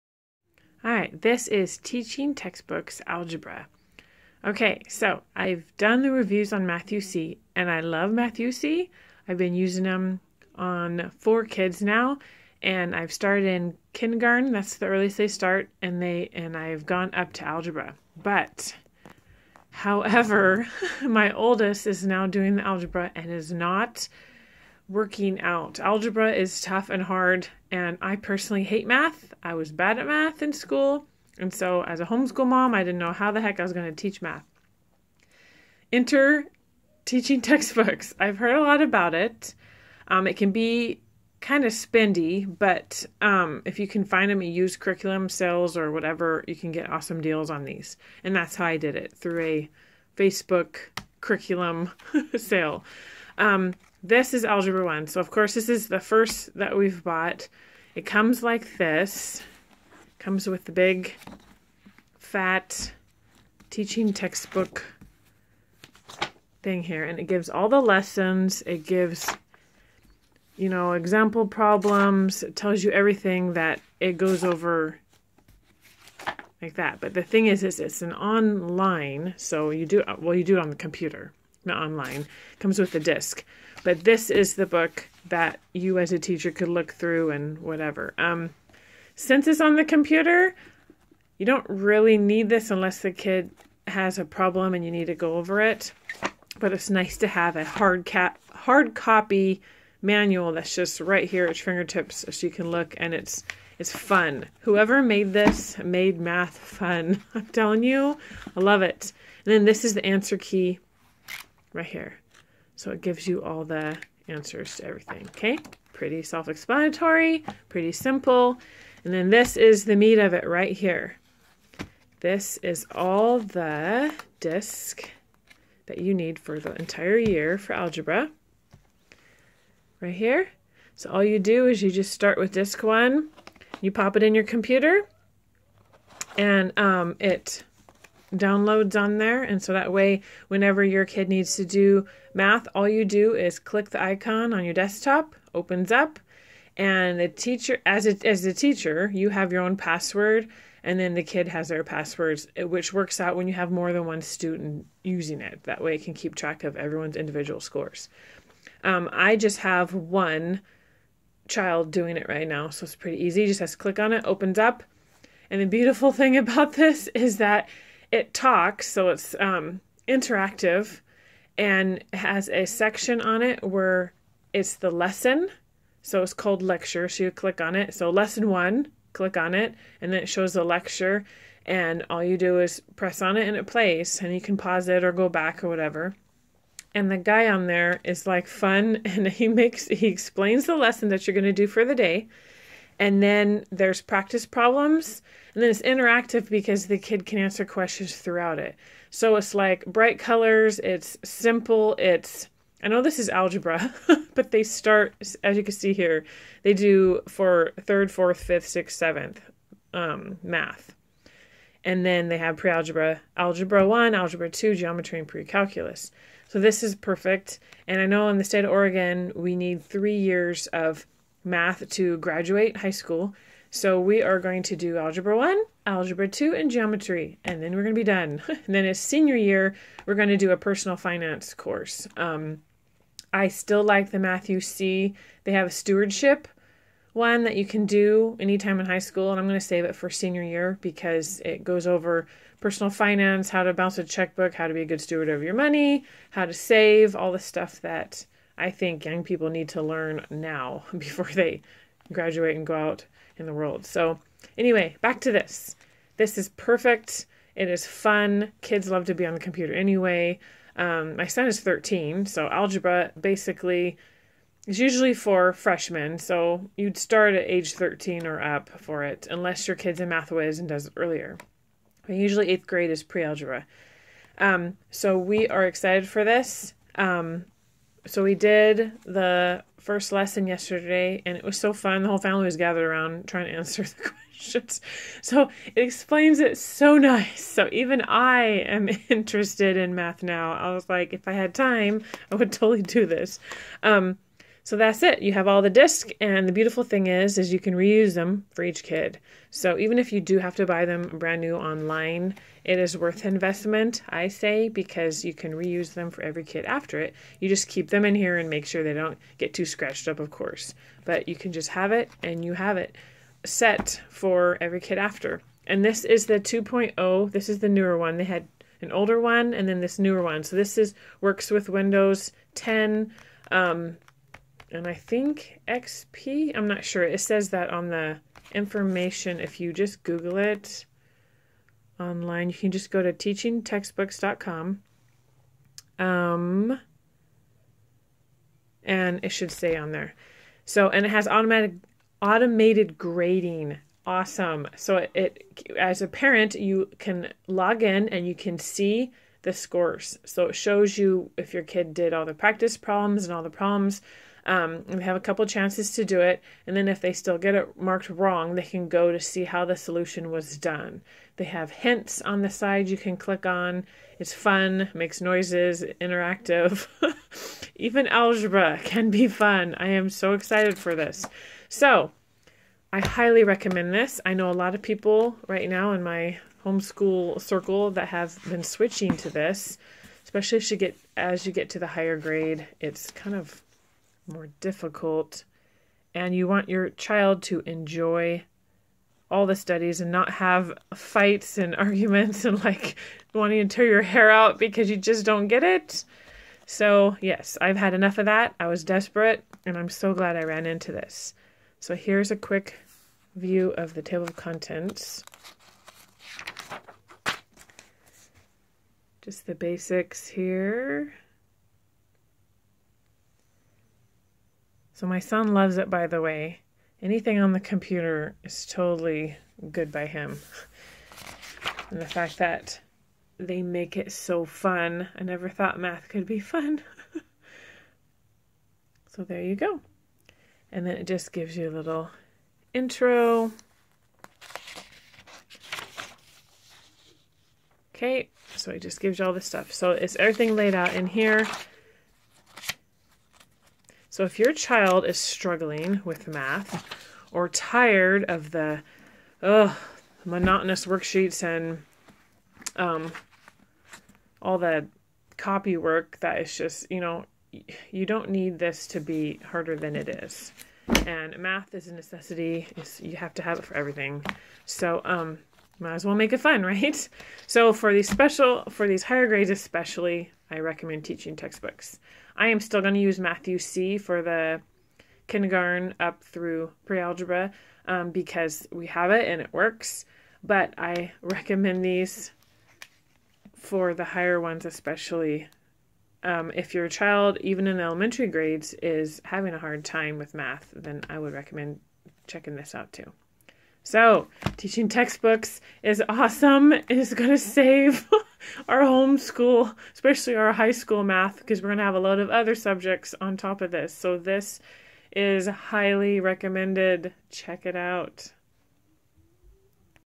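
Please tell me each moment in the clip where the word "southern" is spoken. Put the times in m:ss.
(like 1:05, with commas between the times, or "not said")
not said.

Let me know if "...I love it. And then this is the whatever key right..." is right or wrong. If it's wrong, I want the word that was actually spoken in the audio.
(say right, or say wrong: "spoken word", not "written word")
wrong: "answer", not "whatever".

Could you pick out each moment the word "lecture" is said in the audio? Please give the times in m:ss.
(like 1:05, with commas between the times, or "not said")
2:56, 3:00.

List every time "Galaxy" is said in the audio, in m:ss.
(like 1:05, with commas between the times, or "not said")
not said.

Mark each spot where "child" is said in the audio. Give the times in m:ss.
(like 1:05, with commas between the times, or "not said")
2:41, 6:26, 7:24, 8:06.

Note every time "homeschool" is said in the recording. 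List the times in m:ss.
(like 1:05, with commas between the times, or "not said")
0:32, 6:16, 8:18.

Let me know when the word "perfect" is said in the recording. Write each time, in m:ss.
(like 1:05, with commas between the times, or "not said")
3:36, 4:16.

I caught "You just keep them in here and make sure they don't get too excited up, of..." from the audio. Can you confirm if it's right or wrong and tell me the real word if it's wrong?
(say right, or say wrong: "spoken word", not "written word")
wrong: "scratched", not "excited".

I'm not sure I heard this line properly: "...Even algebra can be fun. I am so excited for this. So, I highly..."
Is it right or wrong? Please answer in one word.
right.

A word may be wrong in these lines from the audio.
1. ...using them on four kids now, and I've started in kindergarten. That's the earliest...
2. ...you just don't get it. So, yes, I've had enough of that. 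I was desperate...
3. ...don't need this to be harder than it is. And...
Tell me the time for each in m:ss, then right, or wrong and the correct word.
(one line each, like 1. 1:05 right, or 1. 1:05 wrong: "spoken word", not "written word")
1. 0:09 right
2. 6:34 right
3. 7:38 right.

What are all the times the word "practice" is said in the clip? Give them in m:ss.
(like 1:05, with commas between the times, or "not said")
3:13, 5:52.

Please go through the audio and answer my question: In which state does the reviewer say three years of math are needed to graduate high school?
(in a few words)
Oregon.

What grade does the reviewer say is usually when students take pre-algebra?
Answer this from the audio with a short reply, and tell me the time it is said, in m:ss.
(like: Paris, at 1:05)
eighth grade, at 4:32.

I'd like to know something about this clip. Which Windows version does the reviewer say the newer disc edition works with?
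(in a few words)
Windows 10.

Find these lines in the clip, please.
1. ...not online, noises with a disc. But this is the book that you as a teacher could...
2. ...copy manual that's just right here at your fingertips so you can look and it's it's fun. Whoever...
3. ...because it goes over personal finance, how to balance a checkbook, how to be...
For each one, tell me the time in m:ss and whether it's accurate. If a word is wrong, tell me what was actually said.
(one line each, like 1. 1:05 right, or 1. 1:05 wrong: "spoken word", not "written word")
1. 1:21 wrong: "comes", not "noises"
2. 1:38 right
3. 4:00 right.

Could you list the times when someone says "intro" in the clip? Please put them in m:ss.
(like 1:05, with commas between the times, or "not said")
7:12.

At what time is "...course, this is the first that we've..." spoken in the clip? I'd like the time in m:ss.
0:55.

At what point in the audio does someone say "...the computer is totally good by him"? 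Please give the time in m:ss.
6:57.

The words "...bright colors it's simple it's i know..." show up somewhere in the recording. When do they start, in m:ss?
3:19.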